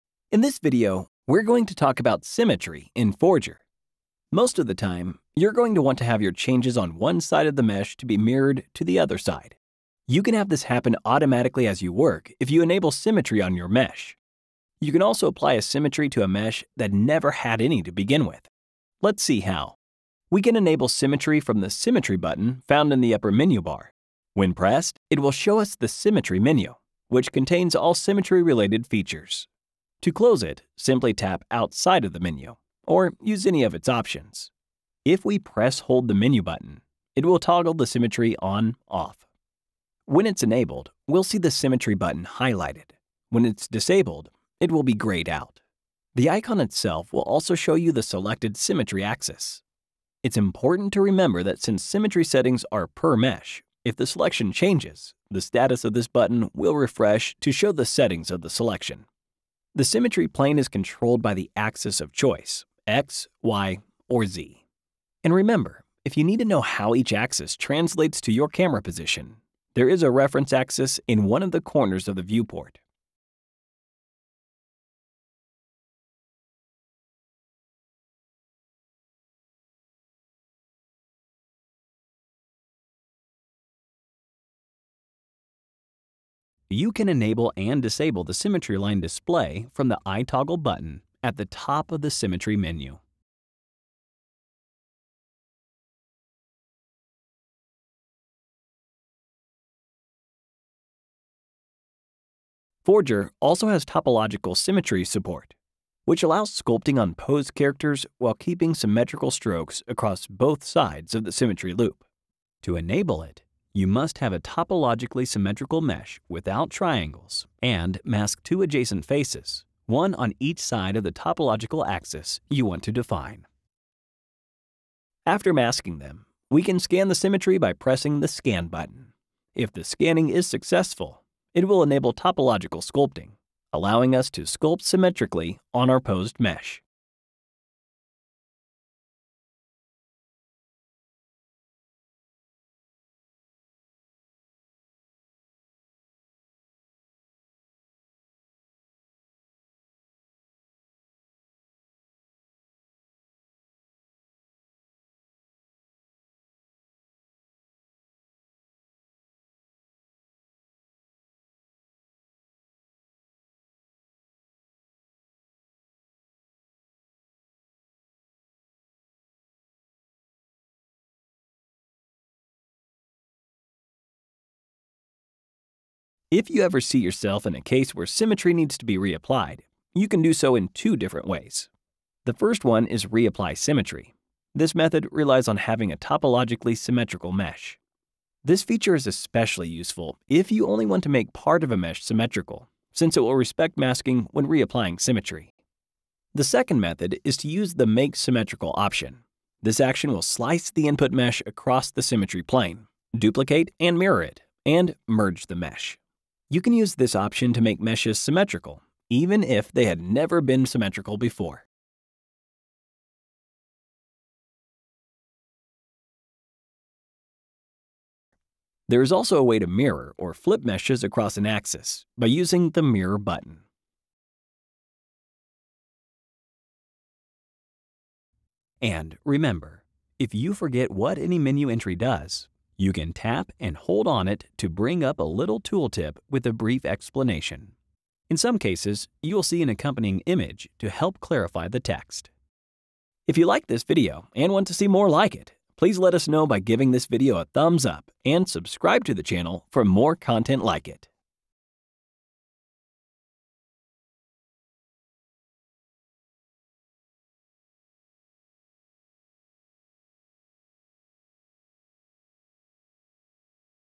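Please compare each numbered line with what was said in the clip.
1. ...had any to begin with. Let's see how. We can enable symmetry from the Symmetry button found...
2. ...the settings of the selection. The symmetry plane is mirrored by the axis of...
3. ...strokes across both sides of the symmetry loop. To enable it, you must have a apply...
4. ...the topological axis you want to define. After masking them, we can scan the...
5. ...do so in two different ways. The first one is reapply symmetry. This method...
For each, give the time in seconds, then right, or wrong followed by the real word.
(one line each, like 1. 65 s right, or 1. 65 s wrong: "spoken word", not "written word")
1. 17 s right
2. 57 s wrong: "controlled", not "mirrored"
3. 109 s wrong: "topologically", not "apply"
4. 121 s right
5. 180 s right.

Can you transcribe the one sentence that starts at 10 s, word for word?
You can have this happen automatically as you work if you enable symmetry on your mesh.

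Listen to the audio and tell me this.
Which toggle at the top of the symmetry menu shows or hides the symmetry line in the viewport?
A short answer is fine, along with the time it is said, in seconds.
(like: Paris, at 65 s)
Eye toggle button, at 90 s.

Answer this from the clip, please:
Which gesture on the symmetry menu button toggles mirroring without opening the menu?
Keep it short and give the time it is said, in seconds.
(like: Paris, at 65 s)
Press hold, at 35 s.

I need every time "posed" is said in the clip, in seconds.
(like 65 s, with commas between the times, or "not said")
107 s, 136 s.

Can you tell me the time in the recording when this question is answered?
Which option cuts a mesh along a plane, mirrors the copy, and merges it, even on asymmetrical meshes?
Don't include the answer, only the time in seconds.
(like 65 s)
197 s.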